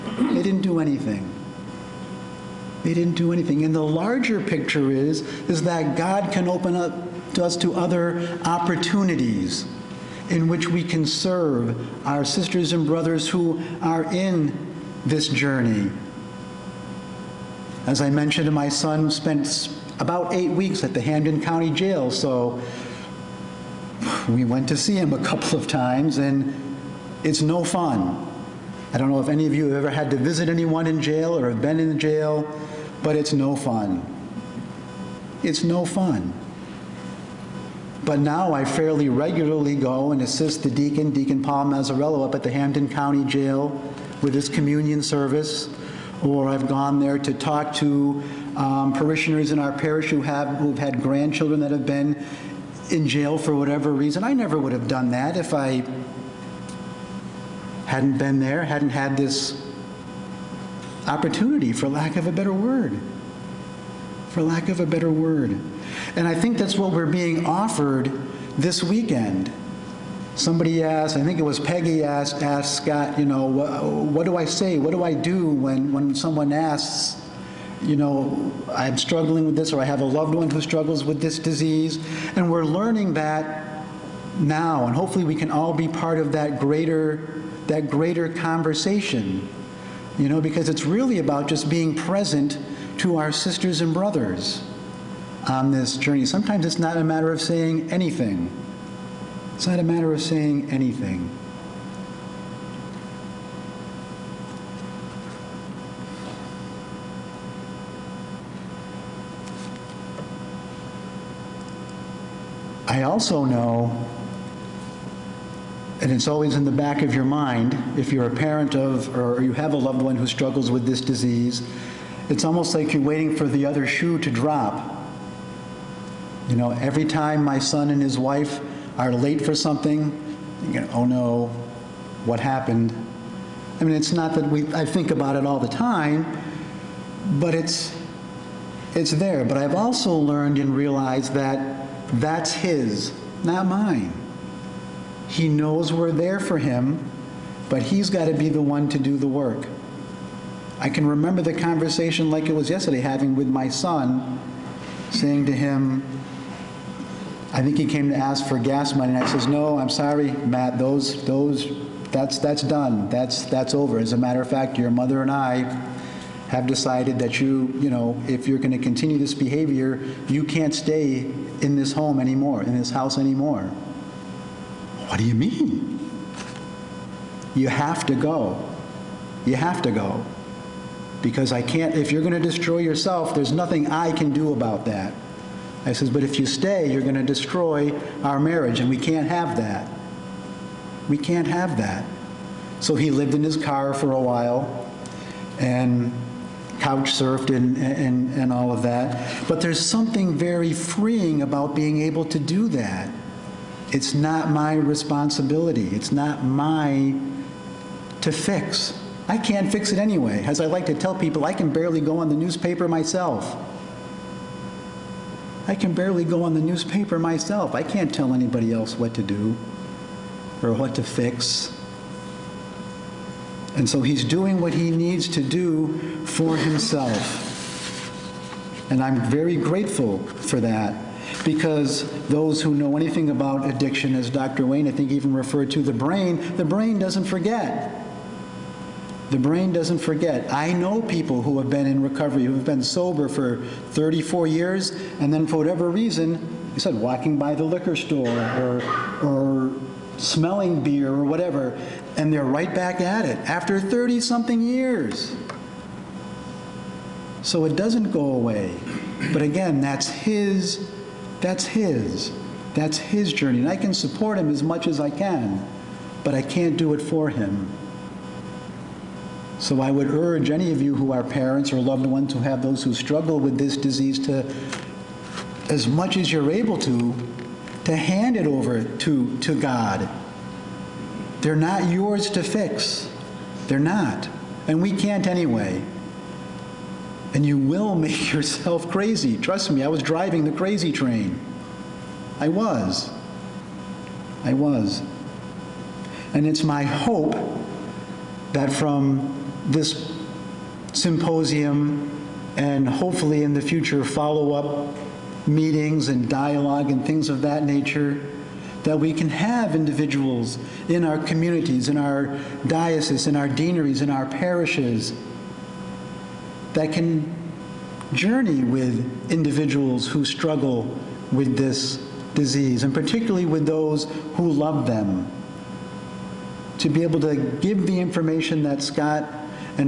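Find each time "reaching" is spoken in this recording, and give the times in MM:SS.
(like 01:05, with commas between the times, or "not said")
not said.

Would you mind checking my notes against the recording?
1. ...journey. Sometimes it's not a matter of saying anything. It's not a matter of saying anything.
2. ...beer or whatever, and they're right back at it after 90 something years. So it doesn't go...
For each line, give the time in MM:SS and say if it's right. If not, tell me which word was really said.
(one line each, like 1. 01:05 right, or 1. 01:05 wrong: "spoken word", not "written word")
1. 01:35 right
2. 04:10 wrong: "30", not "90".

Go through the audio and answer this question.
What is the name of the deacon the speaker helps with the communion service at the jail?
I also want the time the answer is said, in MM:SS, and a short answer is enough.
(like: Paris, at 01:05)
Paul Mazzarello, at 00:41.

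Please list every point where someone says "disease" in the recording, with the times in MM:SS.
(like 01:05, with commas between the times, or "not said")
01:21, 02:01, 04:33, 05:22.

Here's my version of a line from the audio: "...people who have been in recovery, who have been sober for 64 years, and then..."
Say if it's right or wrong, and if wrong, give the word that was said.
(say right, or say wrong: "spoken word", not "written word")
wrong: "34", not "64".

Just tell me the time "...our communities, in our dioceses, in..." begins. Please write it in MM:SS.
05:11.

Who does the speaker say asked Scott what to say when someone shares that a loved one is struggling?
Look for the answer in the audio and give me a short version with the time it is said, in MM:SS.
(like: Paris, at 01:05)
Peggy, at 01:11.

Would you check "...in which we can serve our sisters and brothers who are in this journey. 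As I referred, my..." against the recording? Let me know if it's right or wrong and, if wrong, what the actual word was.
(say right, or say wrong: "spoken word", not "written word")
wrong: "mentioned", not "referred".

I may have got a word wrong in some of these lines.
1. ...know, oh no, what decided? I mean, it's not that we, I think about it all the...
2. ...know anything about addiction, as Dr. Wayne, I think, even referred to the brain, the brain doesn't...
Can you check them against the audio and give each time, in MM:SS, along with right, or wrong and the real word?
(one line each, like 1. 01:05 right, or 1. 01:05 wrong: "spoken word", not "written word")
1. 02:10 wrong: "happened", not "decided"
2. 03:52 right.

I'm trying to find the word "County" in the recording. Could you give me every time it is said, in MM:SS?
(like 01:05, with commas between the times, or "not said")
00:21, 00:42.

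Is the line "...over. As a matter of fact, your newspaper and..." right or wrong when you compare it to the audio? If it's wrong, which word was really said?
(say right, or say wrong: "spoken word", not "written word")
wrong: "mother", not "newspaper".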